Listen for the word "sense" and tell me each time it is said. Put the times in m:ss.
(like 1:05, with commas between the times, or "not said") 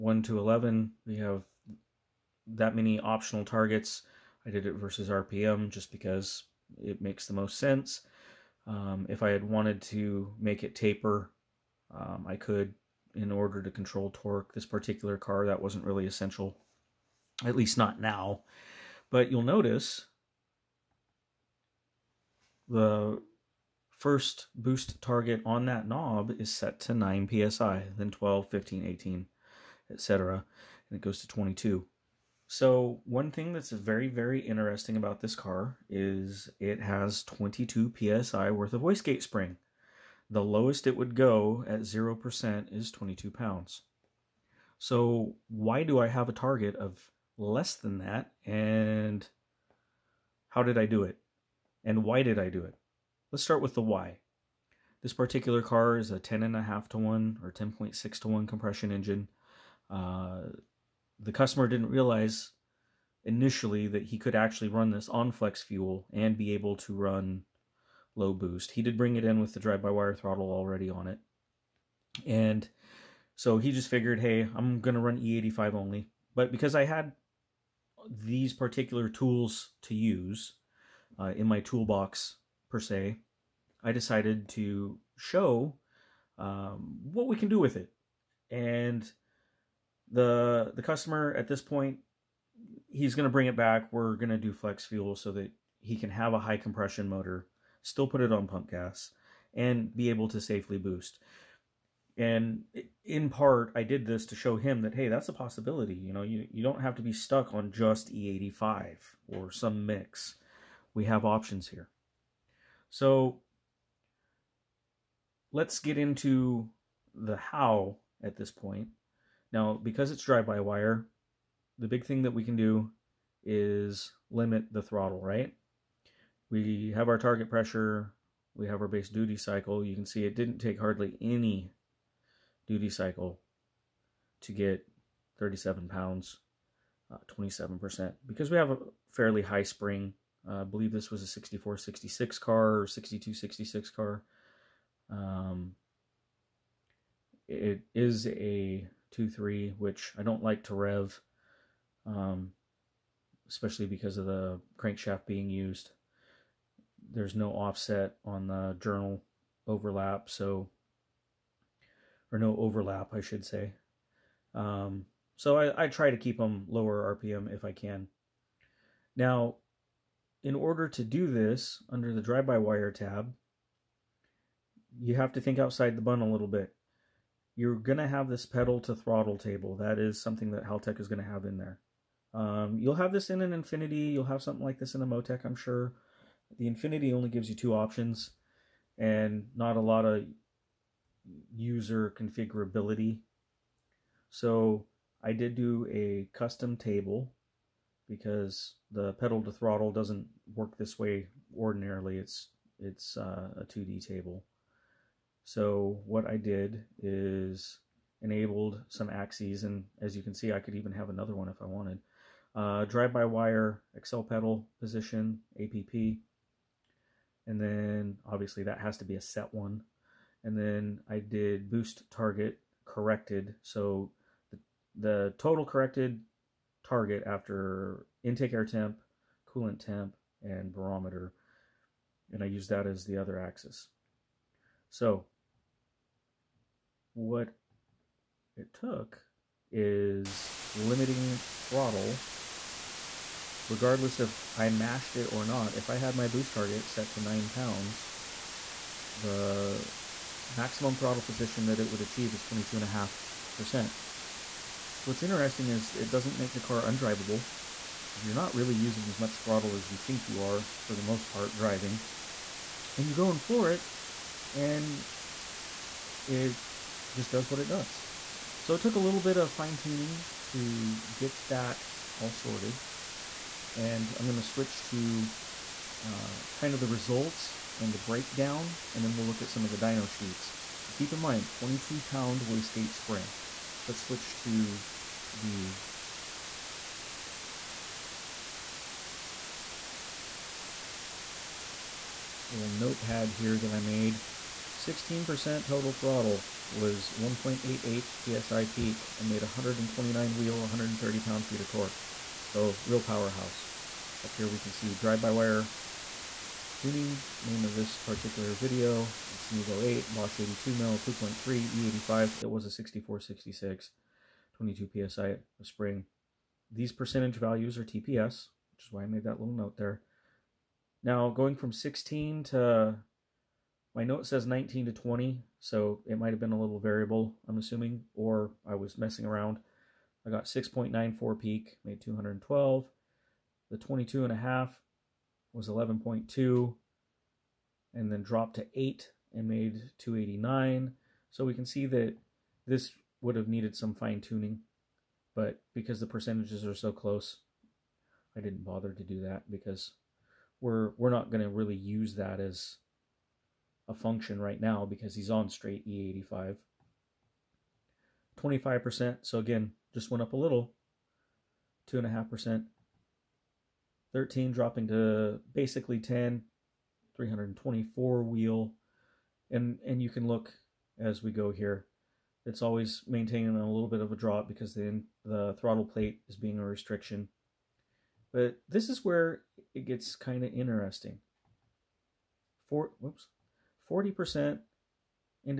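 0:07.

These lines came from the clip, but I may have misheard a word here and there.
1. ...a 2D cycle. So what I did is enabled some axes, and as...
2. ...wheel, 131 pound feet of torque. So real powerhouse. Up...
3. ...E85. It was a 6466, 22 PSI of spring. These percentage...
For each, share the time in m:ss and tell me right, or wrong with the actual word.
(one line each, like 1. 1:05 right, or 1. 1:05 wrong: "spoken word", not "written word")
1. 3:23 wrong: "table", not "cycle"
2. 5:00 wrong: "130", not "131"
3. 5:11 right.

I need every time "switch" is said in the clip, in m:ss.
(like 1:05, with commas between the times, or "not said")
4:34, 4:44.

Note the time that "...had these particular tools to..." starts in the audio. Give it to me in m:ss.
1:16.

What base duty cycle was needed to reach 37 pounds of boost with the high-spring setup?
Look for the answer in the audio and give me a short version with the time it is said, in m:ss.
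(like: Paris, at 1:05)
27%, at 2:17.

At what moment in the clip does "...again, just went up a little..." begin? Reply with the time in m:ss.
5:59.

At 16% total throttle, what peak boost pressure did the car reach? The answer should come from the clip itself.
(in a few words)
1.88 psi.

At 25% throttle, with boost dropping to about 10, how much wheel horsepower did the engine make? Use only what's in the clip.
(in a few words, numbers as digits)
324.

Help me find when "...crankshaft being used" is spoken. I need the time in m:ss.
2:34.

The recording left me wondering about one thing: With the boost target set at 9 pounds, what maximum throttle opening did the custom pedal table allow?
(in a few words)
22.5%.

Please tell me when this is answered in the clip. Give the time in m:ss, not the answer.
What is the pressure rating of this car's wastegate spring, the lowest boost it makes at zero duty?
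0:37.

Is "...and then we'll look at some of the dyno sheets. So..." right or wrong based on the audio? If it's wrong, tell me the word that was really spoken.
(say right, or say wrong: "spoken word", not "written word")
right.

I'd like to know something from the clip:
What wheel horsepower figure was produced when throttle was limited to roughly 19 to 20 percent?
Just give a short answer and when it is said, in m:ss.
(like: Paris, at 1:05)
212, at 5:31.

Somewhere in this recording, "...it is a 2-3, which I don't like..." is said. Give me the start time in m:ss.
2:27.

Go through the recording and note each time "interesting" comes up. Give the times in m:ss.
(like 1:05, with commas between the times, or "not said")
0:34, 4:15, 6:20.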